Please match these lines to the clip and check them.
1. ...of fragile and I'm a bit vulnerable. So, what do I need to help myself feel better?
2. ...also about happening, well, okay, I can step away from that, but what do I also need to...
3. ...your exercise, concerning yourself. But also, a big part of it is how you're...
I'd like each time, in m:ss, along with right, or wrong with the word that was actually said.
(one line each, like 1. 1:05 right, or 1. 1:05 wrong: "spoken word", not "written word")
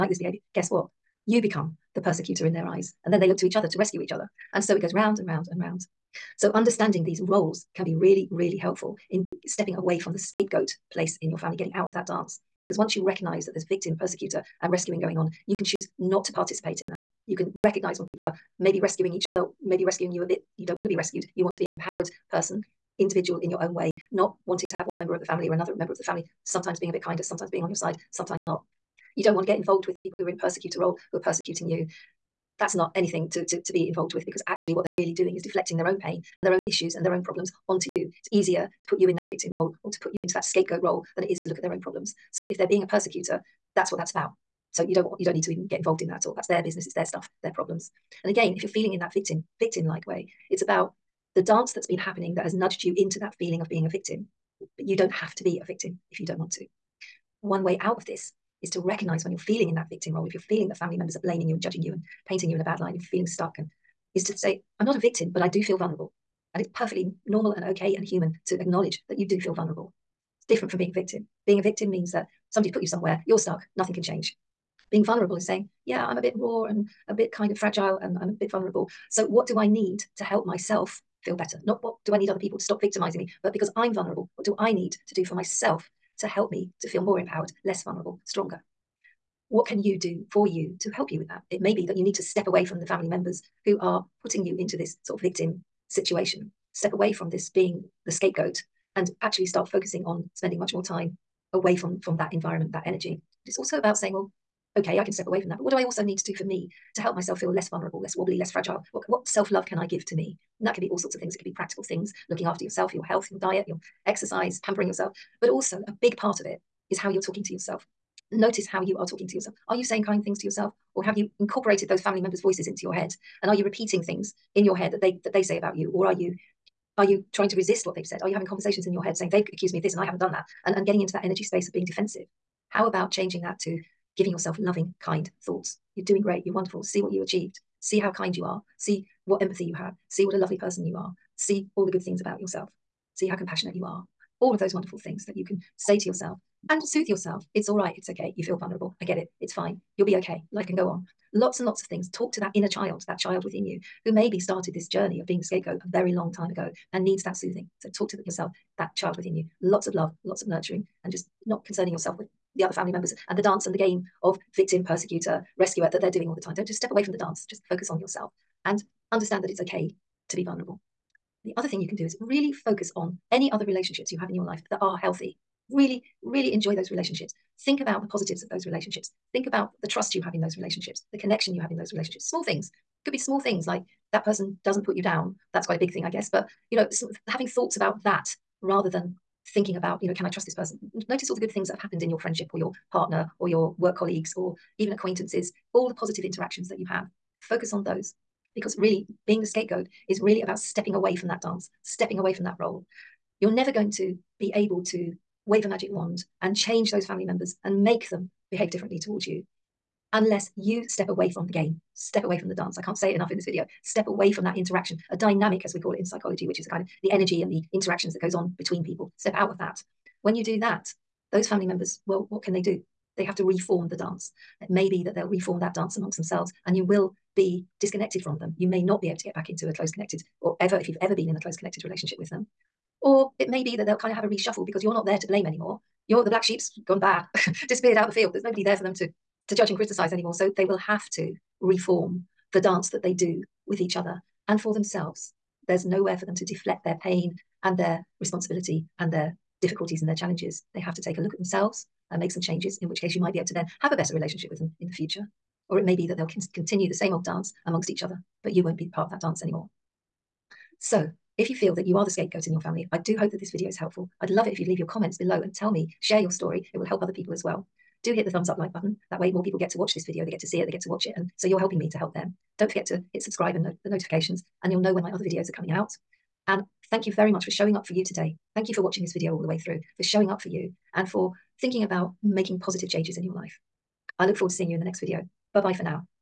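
1. 1:17 right
2. 1:43 wrong: "saying", not "happening"
3. 1:53 wrong: "pampering", not "concerning".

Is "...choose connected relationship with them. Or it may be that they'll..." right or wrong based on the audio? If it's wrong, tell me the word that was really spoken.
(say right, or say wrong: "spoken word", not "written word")
wrong: "close", not "choose".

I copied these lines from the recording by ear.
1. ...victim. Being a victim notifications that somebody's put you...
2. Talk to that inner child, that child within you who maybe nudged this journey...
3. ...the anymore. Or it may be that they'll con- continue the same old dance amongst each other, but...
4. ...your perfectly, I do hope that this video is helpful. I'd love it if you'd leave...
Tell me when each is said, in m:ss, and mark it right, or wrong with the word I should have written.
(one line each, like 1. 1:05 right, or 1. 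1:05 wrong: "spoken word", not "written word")
1. 1:10 wrong: "means", not "notifications"
2. 2:32 wrong: "started", not "nudged"
3. 4:14 wrong: "future", not "anymore"
4. 4:22 wrong: "family", not "perfectly".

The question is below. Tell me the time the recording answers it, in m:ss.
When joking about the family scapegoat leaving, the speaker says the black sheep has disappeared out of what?
3:58.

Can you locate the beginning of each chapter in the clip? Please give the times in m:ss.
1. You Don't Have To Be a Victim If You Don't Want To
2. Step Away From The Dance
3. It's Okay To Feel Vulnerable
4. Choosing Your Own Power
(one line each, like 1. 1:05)
1. 0:54
2. 2:39
3. 1:06
4. 0:16.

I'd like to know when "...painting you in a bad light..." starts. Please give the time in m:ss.
1:02.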